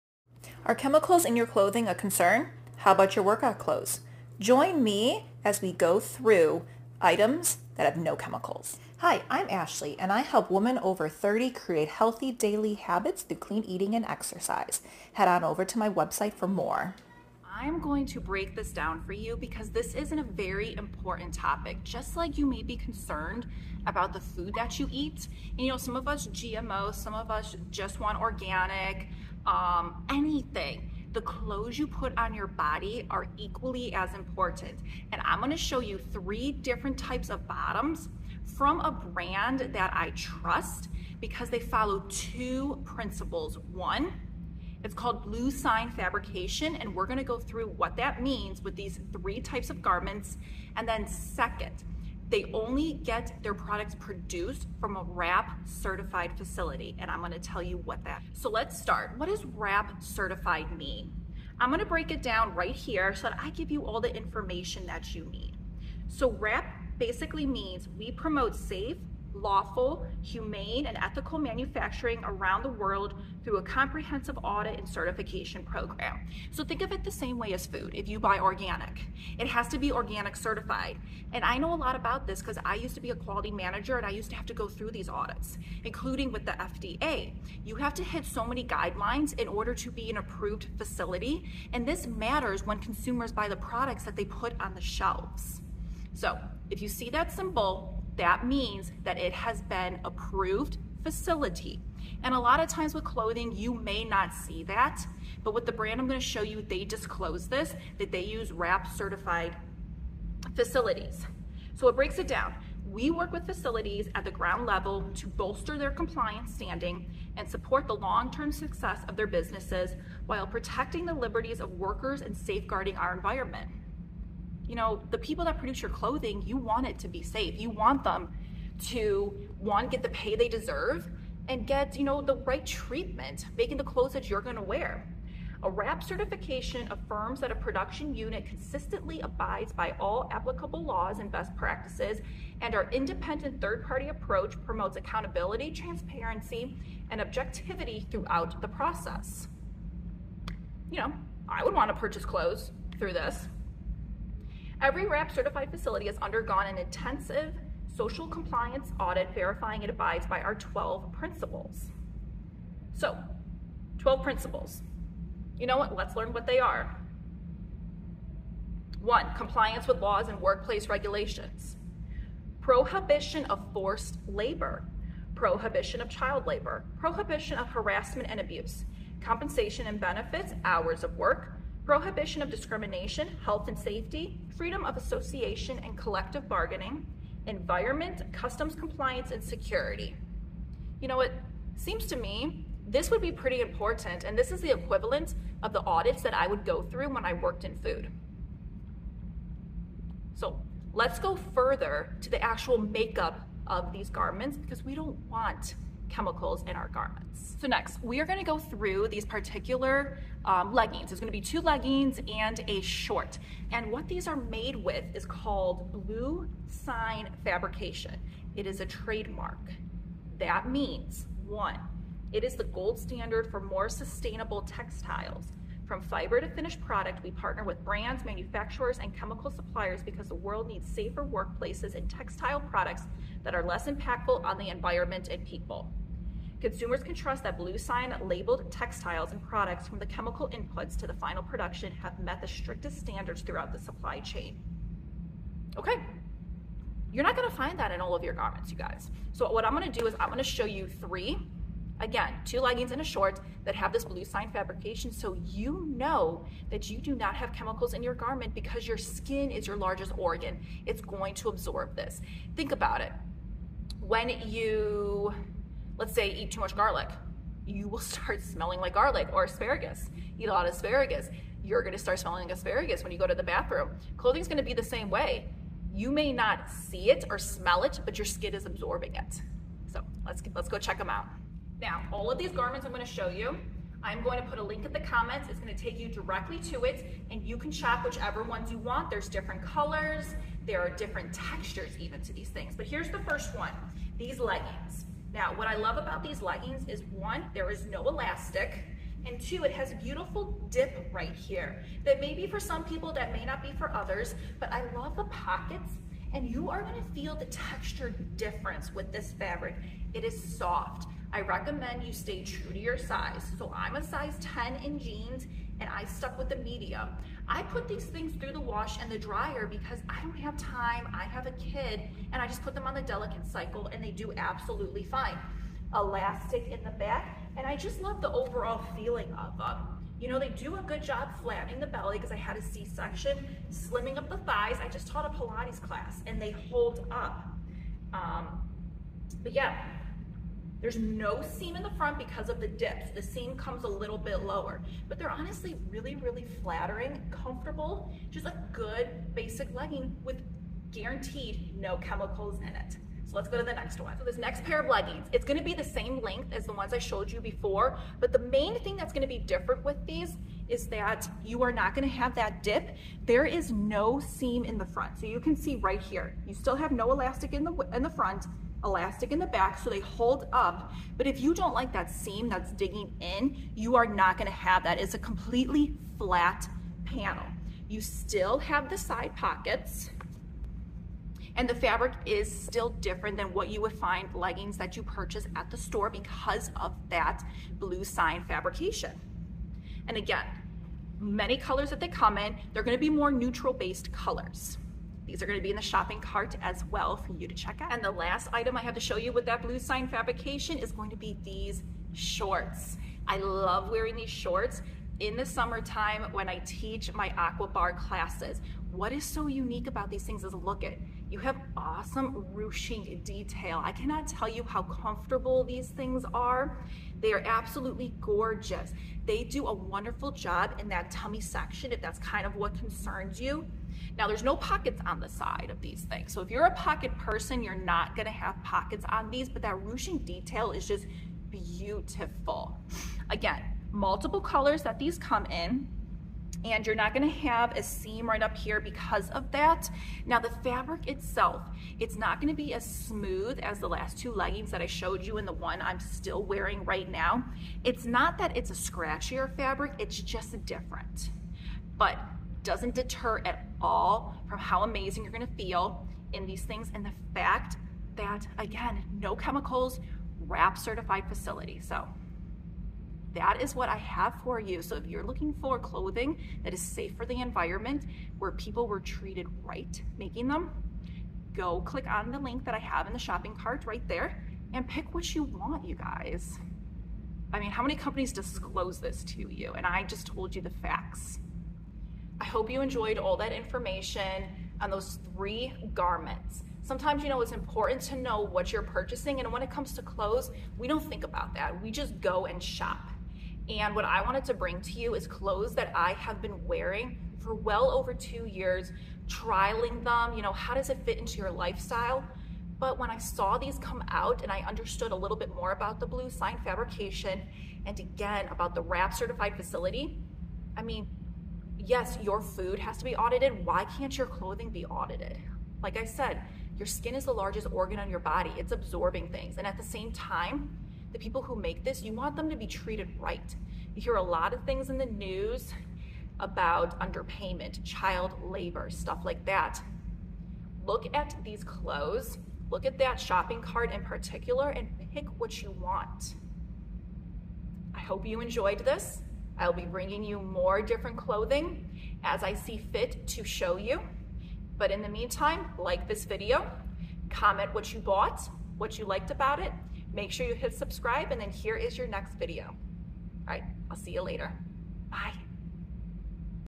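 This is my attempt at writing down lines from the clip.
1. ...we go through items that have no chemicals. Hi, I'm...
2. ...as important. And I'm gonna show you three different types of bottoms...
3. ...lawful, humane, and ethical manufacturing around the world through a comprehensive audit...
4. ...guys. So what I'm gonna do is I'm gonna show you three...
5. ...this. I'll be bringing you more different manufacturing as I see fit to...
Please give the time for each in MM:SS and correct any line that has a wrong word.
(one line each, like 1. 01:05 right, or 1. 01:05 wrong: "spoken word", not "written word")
1. 00:05 right
2. 00:33 right
3. 01:09 right
4. 04:08 right
5. 08:58 wrong: "clothing", not "manufacturing".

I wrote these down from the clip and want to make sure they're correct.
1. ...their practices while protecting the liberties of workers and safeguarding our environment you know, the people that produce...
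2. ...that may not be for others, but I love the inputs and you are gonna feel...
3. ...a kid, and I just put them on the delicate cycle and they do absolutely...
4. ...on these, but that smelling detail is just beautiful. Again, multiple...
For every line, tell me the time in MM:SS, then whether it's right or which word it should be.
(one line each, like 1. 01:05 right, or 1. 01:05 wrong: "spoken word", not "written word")
1. 01:59 wrong: "businesses", not "practices"
2. 05:03 wrong: "pockets", not "inputs"
3. 05:21 right
4. 07:09 wrong: "ruching", not "smelling".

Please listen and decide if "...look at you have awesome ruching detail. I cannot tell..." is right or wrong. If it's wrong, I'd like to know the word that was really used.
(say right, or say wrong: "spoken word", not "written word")
right.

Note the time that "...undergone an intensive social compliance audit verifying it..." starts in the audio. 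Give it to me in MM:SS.
02:36.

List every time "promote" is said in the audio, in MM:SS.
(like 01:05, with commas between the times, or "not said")
01:08, 02:24.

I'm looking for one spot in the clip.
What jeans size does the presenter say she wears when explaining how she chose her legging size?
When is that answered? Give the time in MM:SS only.
05:14.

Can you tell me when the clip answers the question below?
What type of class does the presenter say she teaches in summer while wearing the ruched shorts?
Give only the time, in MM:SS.
06:47.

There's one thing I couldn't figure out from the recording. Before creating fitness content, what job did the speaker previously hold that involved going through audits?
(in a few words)
Quality manager.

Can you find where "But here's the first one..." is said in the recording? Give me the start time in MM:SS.
04:52.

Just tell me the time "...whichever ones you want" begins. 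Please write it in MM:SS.
04:48.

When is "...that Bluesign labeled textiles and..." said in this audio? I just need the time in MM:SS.
03:57.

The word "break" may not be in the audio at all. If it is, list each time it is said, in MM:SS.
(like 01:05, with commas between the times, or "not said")
00:18, 01:01, 01:51.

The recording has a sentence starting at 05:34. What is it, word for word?
I just taught a Pilates class and they hold up.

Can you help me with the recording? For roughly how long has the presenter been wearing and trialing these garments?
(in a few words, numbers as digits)
Over two years.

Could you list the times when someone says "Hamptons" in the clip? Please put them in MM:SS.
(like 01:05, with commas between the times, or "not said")
not said.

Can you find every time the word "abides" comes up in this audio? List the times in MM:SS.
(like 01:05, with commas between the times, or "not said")
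02:19, 02:39.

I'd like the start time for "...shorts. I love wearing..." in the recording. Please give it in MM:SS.
06:42.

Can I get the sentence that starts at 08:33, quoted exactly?
Why can't your clothing be audited?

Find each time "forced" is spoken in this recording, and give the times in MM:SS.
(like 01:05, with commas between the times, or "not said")
02:53.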